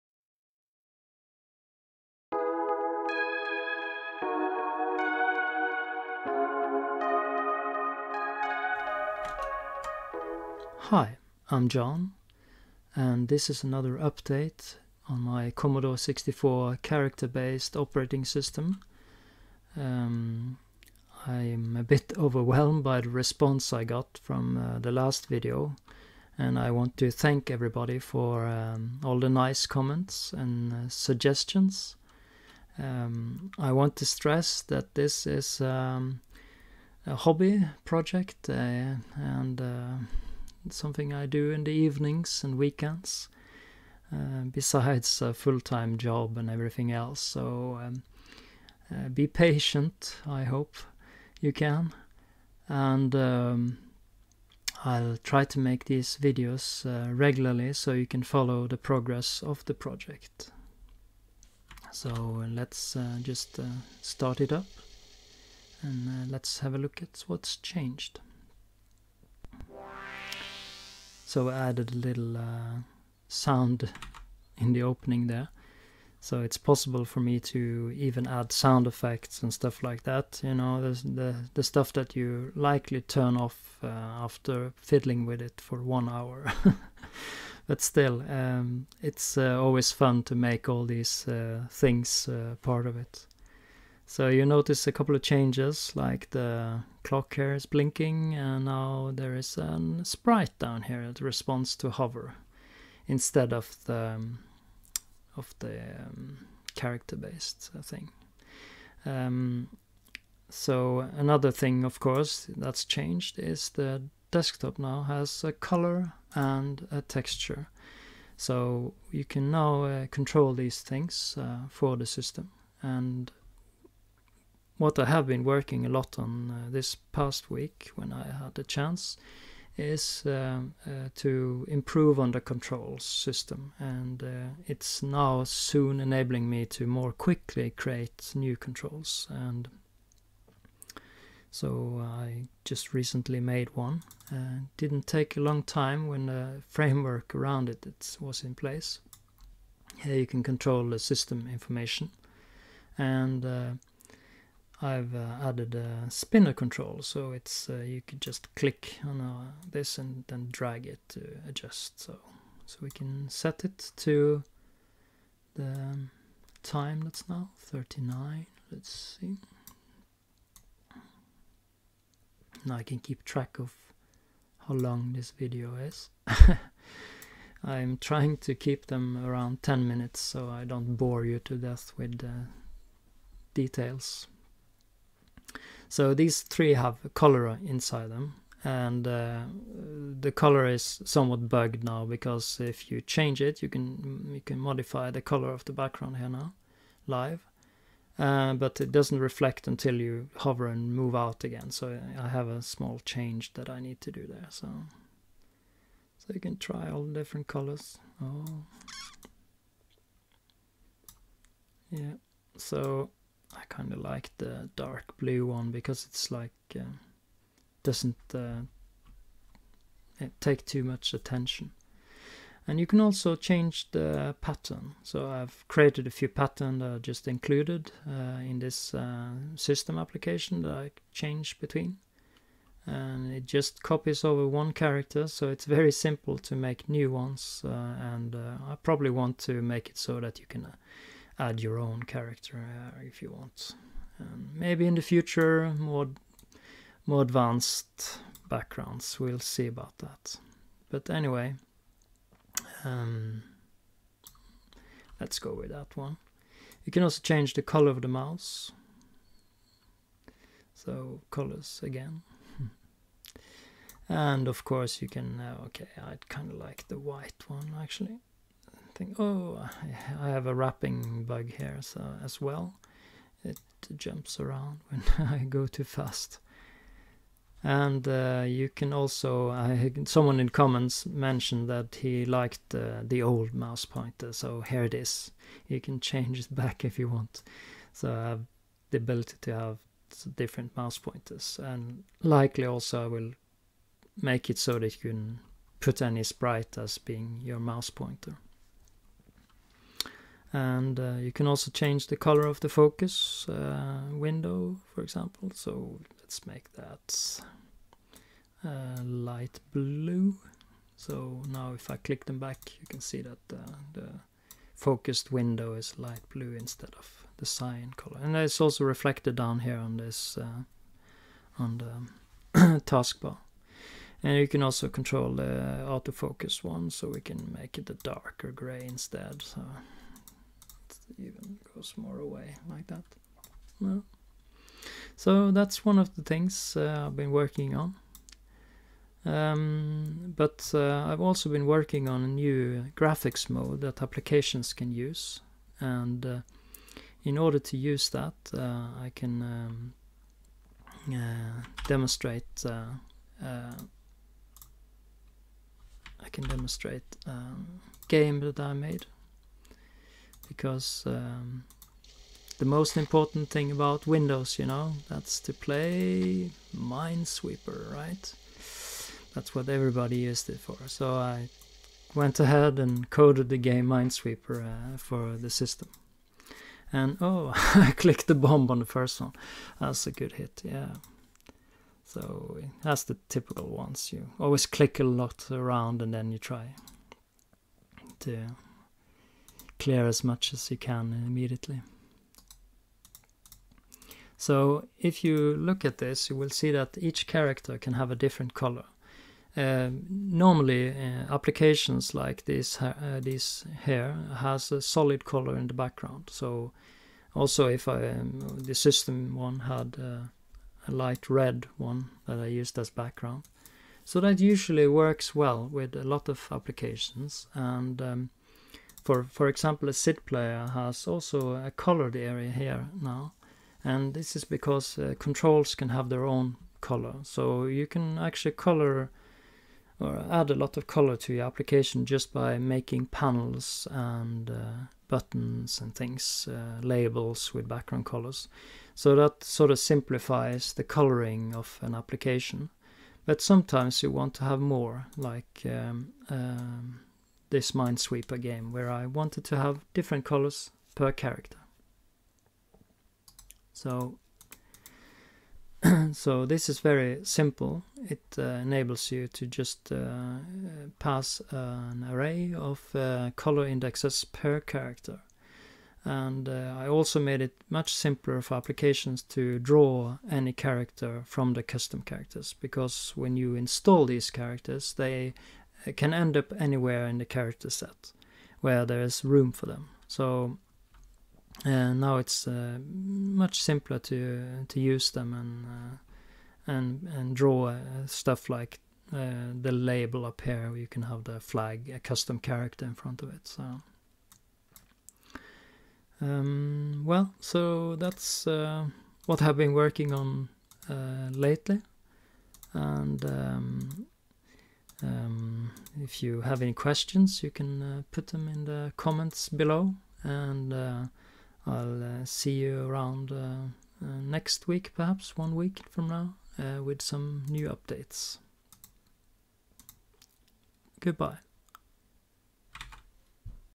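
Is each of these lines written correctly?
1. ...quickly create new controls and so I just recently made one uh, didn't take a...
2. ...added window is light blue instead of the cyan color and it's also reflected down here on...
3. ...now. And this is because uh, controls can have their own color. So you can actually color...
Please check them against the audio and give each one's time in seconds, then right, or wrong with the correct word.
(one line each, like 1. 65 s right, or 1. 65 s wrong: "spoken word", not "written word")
1. 137 s right
2. 314 s wrong: "focused", not "added"
3. 423 s right.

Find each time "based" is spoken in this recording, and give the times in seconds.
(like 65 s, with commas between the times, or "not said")
16 s, 106 s.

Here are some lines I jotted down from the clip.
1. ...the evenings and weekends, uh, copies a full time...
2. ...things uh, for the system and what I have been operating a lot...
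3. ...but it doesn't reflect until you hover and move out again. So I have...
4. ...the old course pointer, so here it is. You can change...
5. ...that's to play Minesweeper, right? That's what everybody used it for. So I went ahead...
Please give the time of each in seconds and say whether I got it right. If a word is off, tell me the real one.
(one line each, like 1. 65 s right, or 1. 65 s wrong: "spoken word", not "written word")
1. 41 s wrong: "besides", not "copies"
2. 120 s wrong: "working", not "operating"
3. 198 s right
4. 283 s wrong: "mouse", not "course"
5. 365 s right.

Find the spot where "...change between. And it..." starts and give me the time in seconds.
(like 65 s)
231 s.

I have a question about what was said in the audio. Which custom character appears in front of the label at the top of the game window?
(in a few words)
the flag.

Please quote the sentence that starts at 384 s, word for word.
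You always click a lot around and then you try to clear as much as you can immediately.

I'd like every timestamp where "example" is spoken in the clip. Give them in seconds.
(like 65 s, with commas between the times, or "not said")
305 s, 419 s.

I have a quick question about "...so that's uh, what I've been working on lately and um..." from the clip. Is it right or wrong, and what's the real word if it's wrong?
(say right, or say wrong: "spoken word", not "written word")
right.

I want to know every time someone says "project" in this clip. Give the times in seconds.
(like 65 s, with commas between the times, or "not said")
37 s, 59 s.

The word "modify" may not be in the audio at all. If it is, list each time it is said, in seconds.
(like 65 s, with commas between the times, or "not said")
194 s.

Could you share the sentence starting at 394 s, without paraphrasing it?
So if you look at this, you will see that each character can have a different color.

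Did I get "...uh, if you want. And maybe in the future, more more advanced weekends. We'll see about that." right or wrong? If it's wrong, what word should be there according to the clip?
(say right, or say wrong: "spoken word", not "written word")
wrong: "backgrounds", not "weekends".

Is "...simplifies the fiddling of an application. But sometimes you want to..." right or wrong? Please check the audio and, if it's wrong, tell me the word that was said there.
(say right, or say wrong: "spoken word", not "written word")
wrong: "coloring", not "fiddling".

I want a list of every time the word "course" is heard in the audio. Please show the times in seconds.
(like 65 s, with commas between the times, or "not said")
112 s, 264 s.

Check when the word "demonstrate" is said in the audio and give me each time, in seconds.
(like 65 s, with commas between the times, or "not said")
351 s, 356 s.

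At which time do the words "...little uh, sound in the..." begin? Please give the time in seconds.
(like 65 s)
72 s.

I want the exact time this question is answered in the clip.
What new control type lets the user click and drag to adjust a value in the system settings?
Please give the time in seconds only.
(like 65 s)
156 s.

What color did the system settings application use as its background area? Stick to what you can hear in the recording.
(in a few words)
light red.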